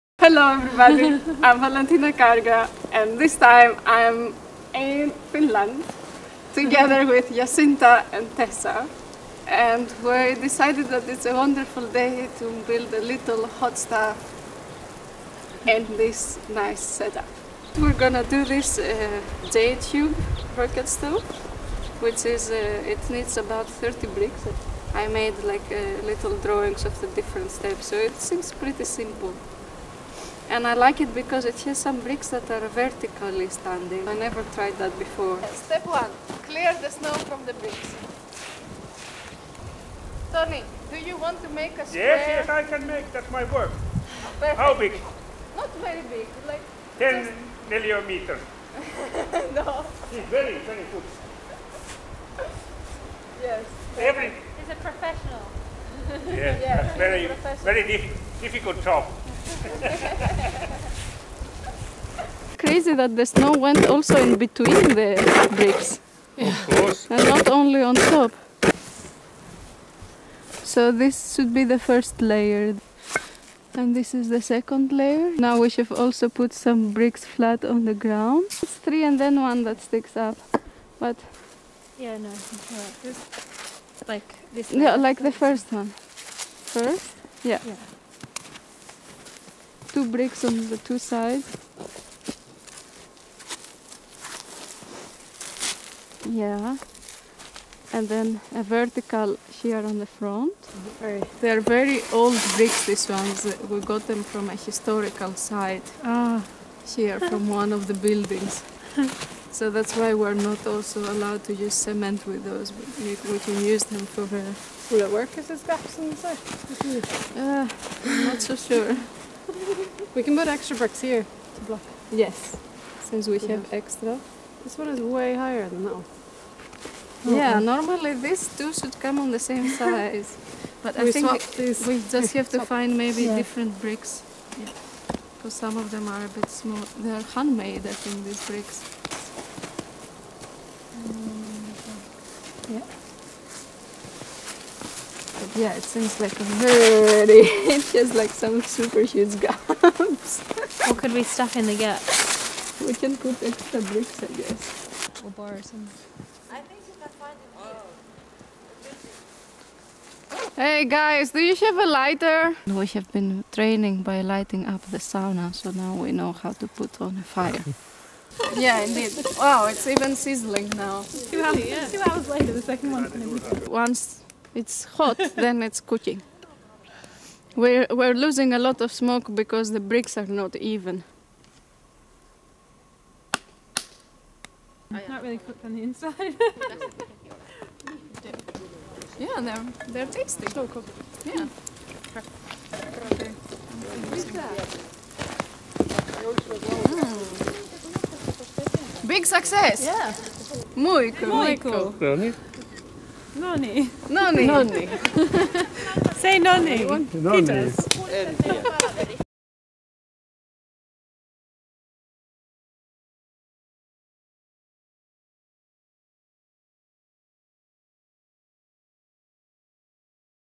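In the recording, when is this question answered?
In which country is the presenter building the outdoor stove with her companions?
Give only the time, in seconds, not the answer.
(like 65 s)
5 s.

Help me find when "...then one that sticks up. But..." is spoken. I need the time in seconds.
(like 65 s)
79 s.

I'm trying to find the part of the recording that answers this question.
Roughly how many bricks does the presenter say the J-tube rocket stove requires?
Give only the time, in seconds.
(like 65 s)
23 s.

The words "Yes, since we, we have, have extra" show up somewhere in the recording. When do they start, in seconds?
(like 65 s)
122 s.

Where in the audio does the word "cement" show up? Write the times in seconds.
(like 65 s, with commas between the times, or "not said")
111 s.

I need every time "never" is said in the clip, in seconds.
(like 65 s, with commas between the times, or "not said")
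34 s.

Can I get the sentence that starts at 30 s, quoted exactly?
And I like it because it has some bricks that are vertically standing.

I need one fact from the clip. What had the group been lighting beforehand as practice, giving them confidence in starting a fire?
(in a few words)
the sauna.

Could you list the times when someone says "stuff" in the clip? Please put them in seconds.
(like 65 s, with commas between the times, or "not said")
13 s, 151 s.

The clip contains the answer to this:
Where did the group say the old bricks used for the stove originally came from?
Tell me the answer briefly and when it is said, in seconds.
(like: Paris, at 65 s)
a historical site, at 104 s.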